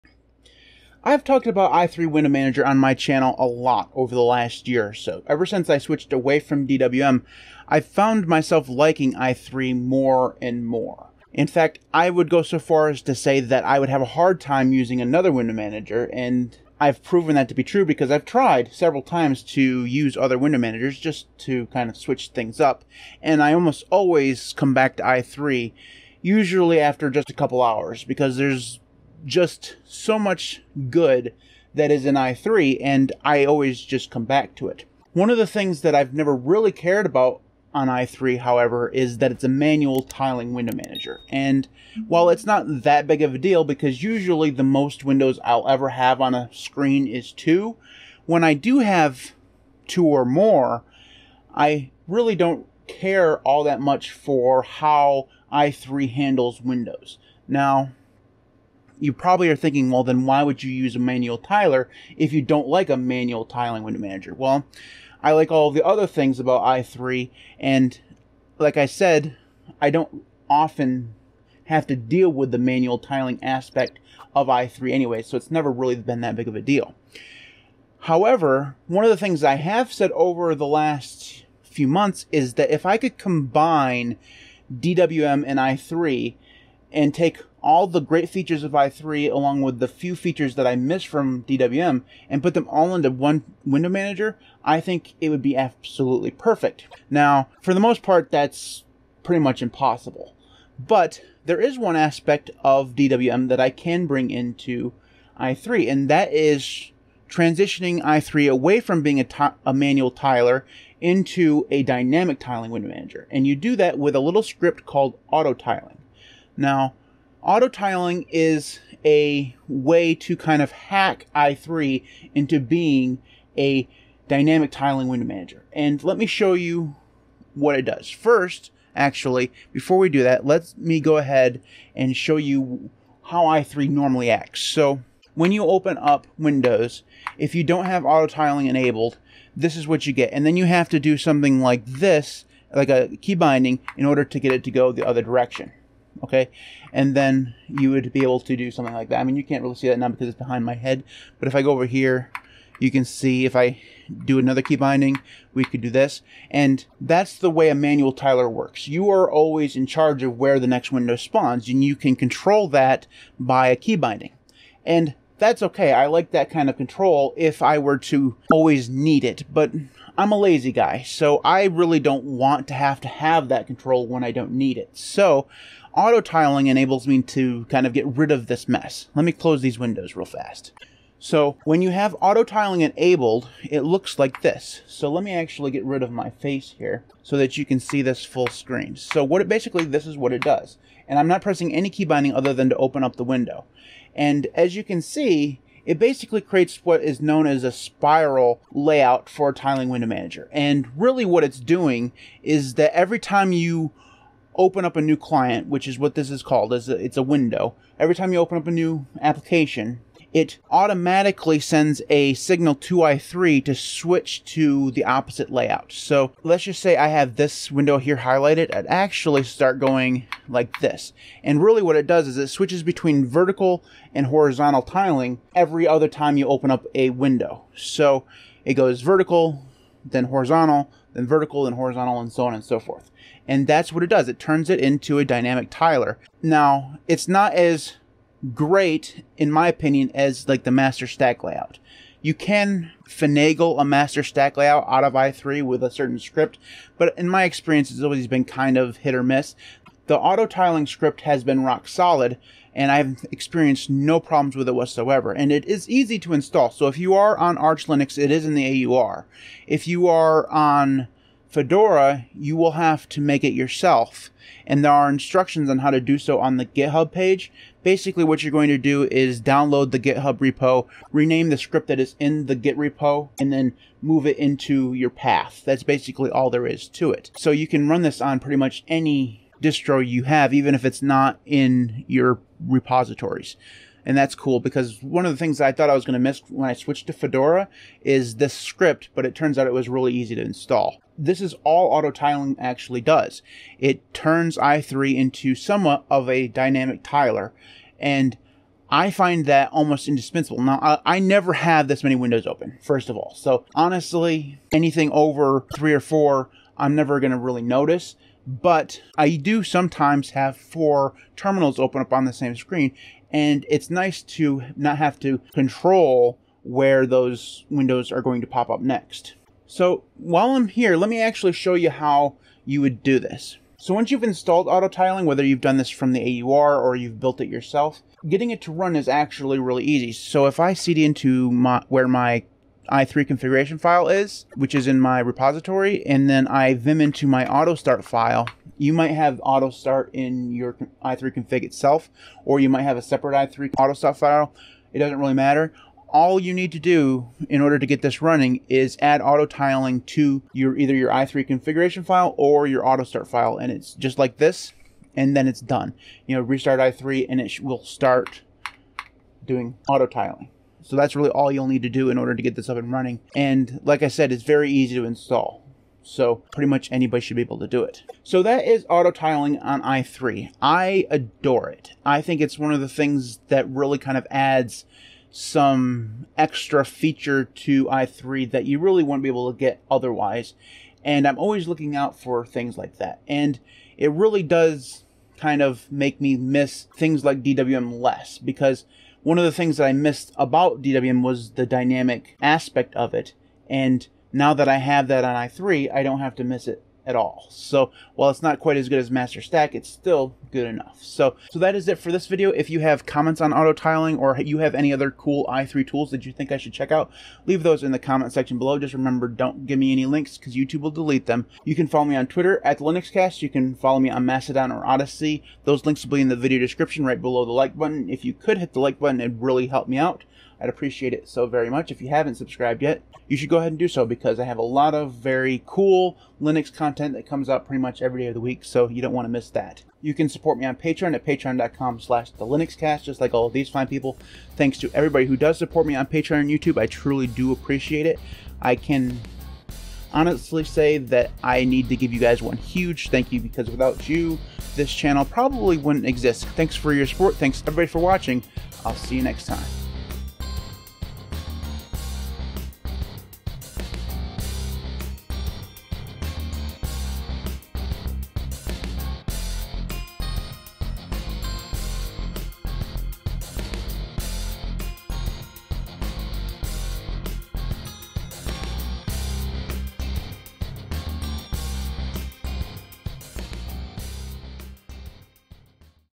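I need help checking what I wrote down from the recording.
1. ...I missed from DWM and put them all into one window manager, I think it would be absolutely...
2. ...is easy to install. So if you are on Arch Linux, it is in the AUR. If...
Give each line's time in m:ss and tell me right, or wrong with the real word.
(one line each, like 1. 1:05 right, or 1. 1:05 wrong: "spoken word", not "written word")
1. 1:30 right
2. 4:15 right.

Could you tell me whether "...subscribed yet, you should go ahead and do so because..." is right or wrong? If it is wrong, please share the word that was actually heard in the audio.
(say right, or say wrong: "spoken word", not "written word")
right.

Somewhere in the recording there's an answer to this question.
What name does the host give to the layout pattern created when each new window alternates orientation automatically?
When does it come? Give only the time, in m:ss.
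3:17.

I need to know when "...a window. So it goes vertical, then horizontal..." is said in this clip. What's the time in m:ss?
3:46.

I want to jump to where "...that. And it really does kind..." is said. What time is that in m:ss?
6:22.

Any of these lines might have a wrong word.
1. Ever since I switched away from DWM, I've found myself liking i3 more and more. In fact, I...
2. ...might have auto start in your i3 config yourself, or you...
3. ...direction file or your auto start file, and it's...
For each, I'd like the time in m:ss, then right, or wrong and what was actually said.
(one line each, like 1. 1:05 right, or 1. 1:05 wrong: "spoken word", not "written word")
1. 0:05 right
2. 5:38 wrong: "itself", not "yourself"
3. 5:51 wrong: "configuration", not "direction".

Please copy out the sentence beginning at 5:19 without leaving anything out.
So while I'm here, let me actually show you how you would do this.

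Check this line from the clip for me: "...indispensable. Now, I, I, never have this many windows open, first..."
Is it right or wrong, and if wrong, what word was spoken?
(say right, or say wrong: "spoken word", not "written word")
right.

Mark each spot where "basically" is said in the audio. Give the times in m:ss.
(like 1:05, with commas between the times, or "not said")
3:09, 3:15, 4:27, 4:35.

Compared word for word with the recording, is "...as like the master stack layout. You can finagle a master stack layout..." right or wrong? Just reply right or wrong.
right.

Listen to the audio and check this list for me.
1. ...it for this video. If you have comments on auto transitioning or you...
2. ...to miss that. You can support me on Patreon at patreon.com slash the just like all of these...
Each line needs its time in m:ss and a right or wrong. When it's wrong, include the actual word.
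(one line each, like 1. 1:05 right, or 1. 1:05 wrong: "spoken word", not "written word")
1. 6:41 wrong: "tiling", not "transitioning"
2. 7:09 right.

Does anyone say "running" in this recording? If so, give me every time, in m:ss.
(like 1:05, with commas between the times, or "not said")
5:48, 6:02.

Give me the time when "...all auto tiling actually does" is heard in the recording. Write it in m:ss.
4:51.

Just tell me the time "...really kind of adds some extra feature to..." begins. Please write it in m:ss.
6:13.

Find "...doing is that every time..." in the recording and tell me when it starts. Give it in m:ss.
3:21.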